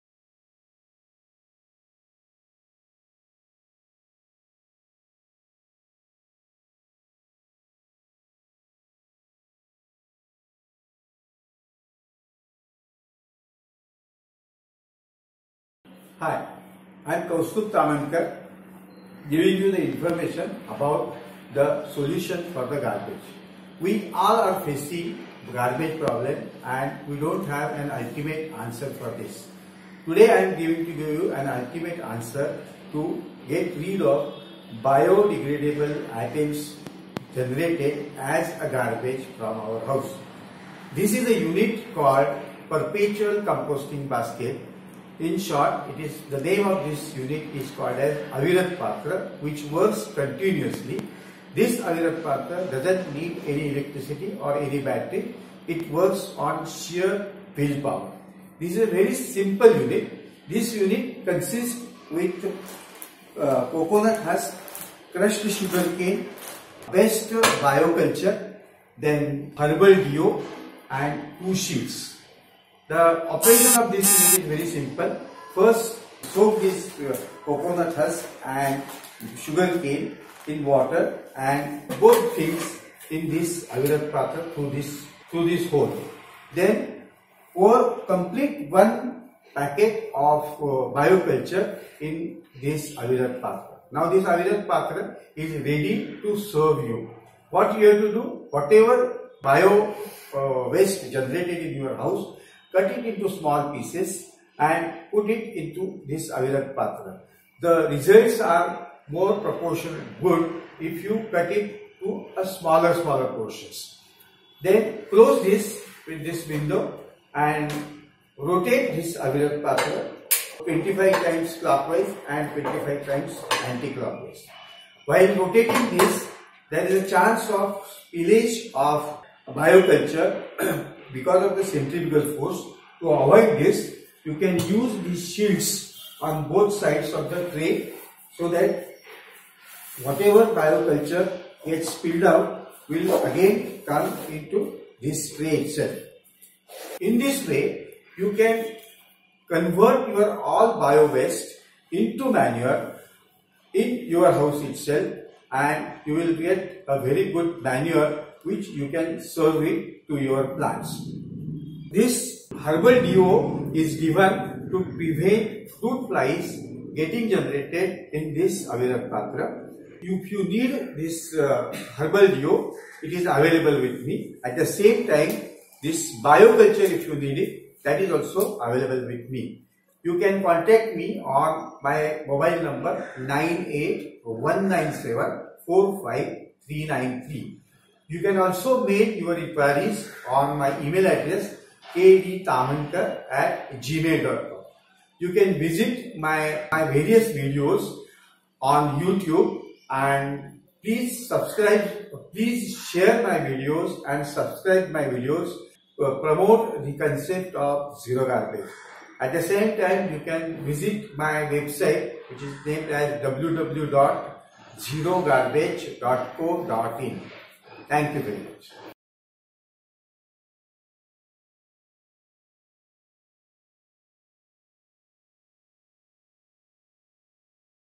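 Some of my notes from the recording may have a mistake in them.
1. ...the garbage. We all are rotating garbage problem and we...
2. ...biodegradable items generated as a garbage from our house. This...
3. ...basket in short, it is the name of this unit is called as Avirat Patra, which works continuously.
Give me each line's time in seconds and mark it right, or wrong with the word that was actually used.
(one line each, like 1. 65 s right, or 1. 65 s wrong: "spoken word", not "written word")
1. 22 s wrong: "facing", not "rotating"
2. 34 s right
3. 44 s right.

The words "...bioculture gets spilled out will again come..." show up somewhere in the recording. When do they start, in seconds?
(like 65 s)
140 s.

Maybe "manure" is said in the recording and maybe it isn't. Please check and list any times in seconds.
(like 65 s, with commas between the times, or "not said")
152 s, 157 s.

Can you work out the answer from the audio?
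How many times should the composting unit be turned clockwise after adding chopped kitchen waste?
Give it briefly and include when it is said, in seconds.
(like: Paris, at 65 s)
25, at 120 s.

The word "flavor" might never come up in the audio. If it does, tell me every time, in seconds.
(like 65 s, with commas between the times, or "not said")
not said.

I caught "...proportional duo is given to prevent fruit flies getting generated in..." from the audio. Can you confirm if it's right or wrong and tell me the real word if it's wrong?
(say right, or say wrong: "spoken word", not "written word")
wrong: "herbal", not "proportional".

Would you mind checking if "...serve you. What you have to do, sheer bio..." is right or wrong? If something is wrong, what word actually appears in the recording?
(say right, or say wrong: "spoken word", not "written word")
wrong: "whatever", not "sheer".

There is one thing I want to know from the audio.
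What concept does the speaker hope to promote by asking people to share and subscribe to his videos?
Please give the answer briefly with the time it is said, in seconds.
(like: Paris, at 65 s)
Zero garbage, at 208 s.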